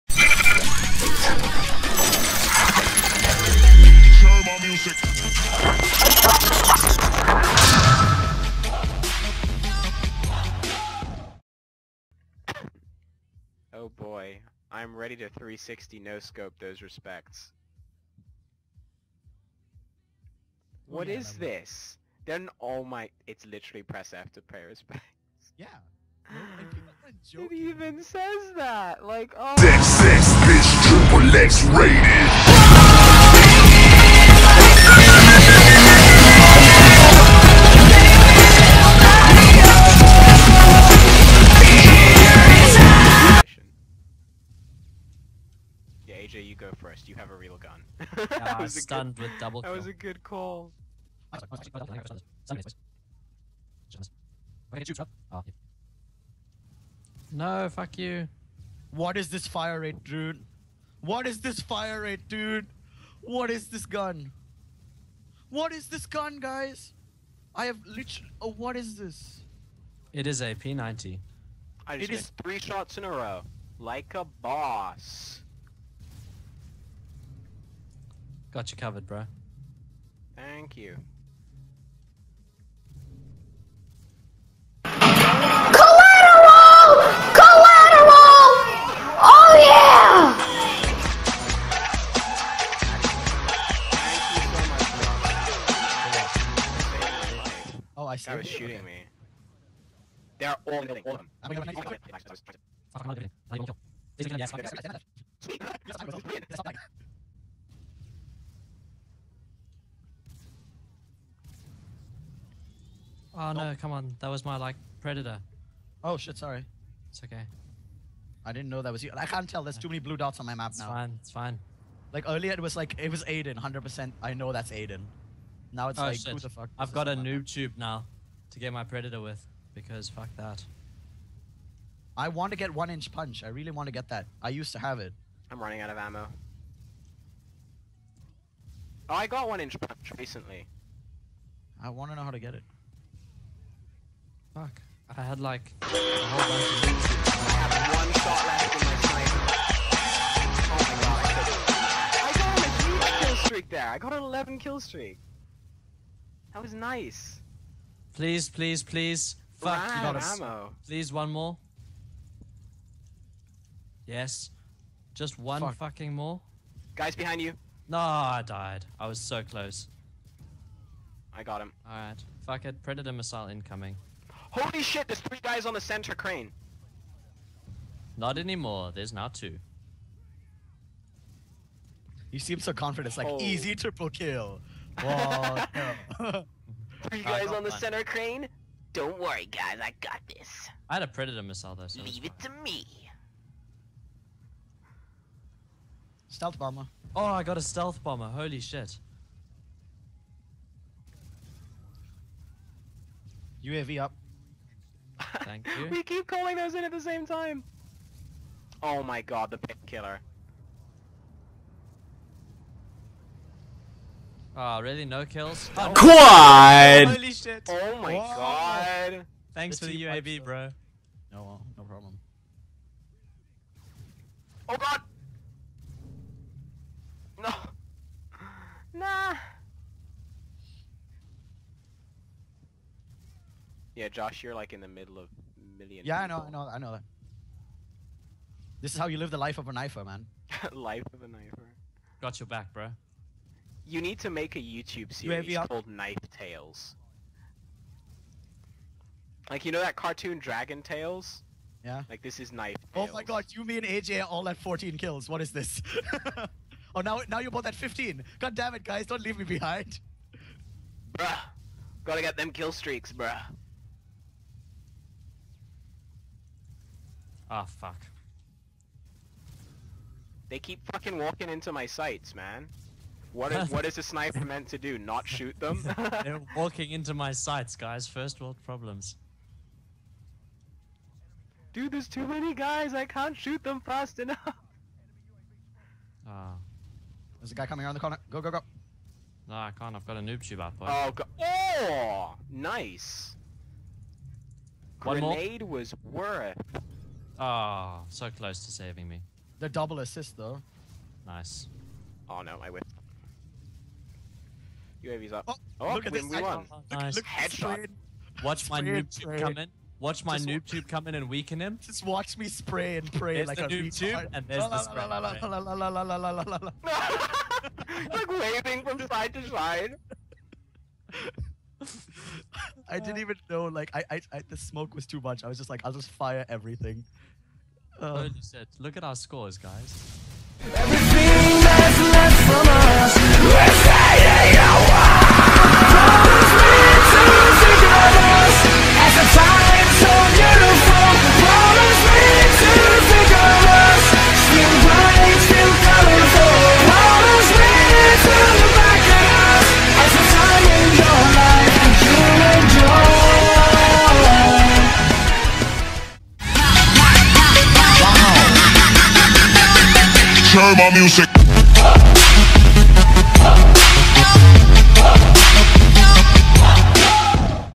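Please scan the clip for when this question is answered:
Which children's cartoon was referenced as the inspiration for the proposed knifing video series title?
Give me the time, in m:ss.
4:10.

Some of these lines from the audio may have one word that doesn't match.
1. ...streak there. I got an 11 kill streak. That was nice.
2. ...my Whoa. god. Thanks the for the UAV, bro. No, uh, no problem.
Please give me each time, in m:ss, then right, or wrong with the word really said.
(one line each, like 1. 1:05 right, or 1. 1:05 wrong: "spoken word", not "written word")
1. 2:33 right
2. 3:38 right.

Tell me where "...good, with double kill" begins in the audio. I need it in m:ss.
0:49.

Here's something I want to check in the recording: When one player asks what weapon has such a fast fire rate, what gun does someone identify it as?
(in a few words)
P90.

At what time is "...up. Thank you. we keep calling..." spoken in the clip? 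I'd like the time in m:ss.
3:24.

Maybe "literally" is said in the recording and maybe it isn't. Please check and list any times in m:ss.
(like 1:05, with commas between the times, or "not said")
0:23, 1:07.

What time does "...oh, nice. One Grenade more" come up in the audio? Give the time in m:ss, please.
4:51.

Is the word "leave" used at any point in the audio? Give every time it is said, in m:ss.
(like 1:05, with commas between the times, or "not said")
3:12, 4:19.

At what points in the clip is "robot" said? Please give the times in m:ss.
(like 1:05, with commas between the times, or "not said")
not said.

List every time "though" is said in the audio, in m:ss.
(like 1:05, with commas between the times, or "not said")
3:11, 5:00.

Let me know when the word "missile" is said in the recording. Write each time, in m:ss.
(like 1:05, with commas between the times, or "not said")
2:53, 3:11.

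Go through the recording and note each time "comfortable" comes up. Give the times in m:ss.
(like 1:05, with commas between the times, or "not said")
not said.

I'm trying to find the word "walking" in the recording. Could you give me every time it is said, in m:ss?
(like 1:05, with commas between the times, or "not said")
4:31, 4:36.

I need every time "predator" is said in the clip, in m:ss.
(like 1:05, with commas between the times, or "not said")
1:54, 2:08, 2:52, 3:11.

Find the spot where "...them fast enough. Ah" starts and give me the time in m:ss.
4:43.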